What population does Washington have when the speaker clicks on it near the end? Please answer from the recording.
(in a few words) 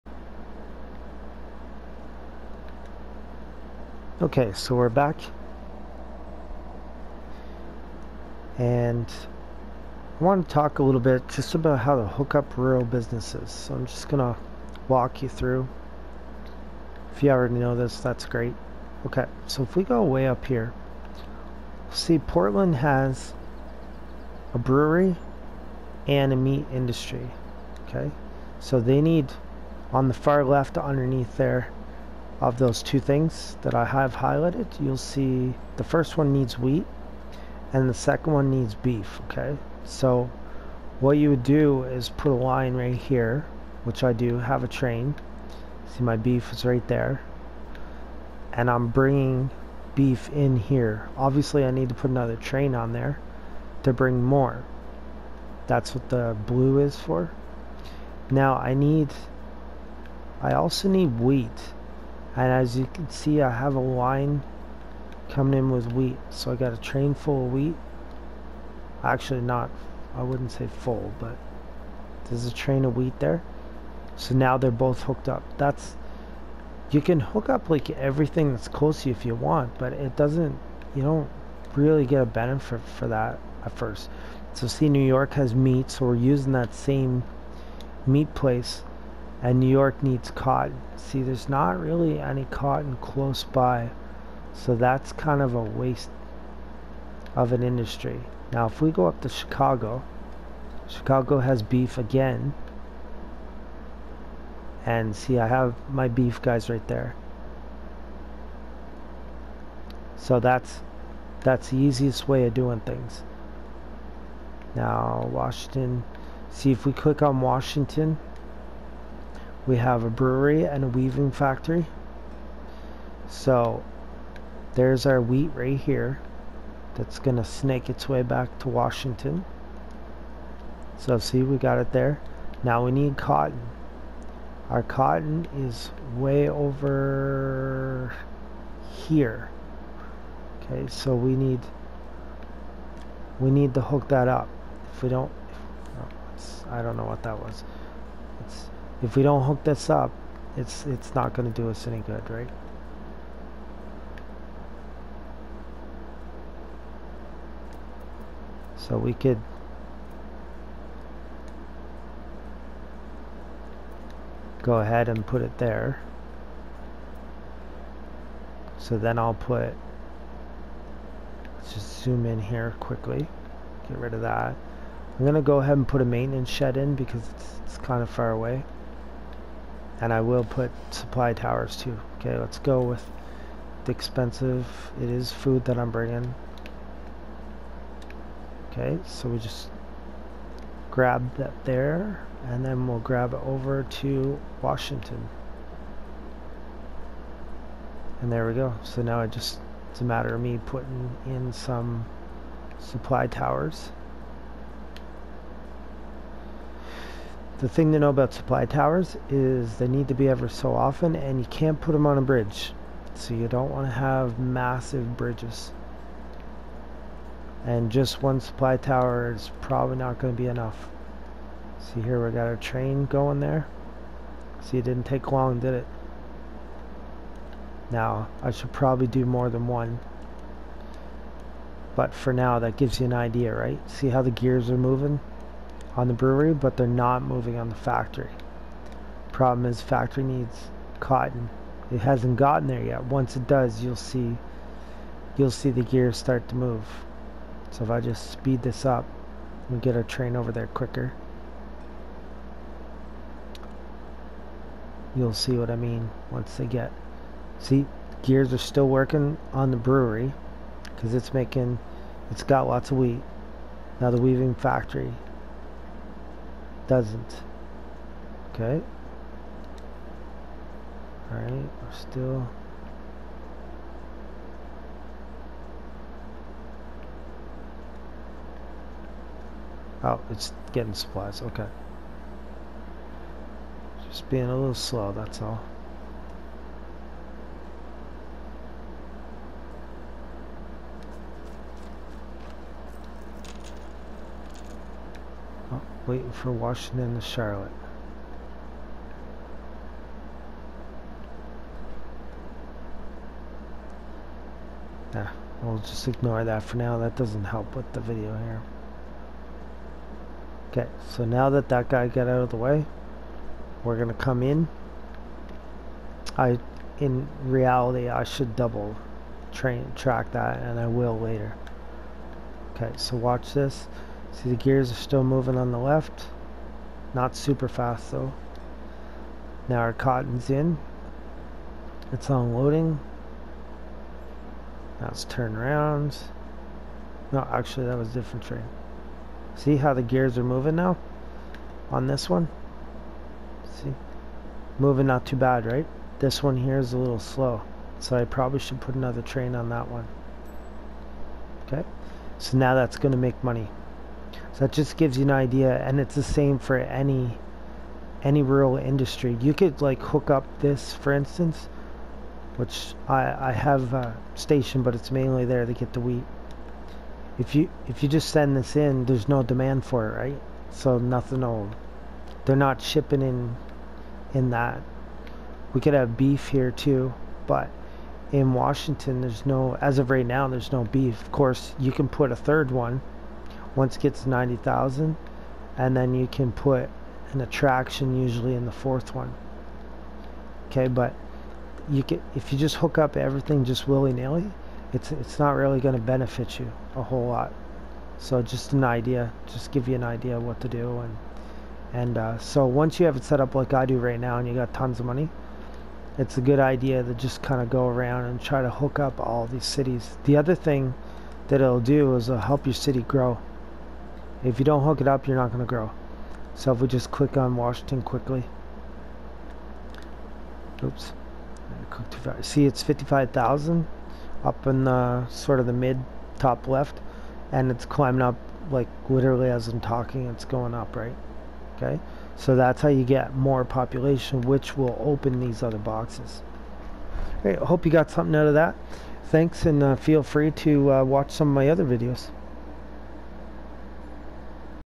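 55,000.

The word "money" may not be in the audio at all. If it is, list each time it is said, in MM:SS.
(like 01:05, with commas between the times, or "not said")
05:53, 06:45.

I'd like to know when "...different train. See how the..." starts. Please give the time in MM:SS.
05:38.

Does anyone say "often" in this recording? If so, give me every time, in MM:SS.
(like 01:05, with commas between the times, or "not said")
03:30.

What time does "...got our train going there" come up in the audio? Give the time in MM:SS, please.
03:42.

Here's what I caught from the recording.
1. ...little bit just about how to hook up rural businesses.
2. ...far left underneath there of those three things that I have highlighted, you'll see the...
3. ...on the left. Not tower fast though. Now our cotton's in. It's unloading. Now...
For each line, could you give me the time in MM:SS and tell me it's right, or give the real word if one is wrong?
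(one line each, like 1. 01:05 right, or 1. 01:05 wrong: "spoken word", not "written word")
1. 00:10 right
2. 00:30 wrong: "two", not "three"
3. 05:25 wrong: "super", not "tower".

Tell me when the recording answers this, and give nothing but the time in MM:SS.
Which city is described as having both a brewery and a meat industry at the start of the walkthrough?
00:22.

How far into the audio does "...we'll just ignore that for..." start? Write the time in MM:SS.
05:05.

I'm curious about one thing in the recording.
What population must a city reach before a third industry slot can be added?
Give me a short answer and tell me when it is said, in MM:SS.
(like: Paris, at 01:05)
90,000, at 06:24.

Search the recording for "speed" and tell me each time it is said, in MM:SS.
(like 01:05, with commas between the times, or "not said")
04:08.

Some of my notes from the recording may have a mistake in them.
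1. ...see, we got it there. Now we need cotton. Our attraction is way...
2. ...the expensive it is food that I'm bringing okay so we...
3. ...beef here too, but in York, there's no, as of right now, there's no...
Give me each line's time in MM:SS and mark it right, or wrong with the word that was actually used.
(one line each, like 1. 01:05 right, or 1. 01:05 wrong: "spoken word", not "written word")
1. 02:11 wrong: "cotton", not "attraction"
2. 03:03 right
3. 06:16 wrong: "Washington", not "York".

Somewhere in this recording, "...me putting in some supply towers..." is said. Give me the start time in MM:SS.
03:20.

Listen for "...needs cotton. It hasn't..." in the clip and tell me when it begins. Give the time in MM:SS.
04:00.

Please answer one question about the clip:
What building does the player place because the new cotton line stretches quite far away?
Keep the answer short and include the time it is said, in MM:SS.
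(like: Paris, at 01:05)
Maintenance shed, at 02:56.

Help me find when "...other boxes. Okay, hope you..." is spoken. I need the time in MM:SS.
07:15.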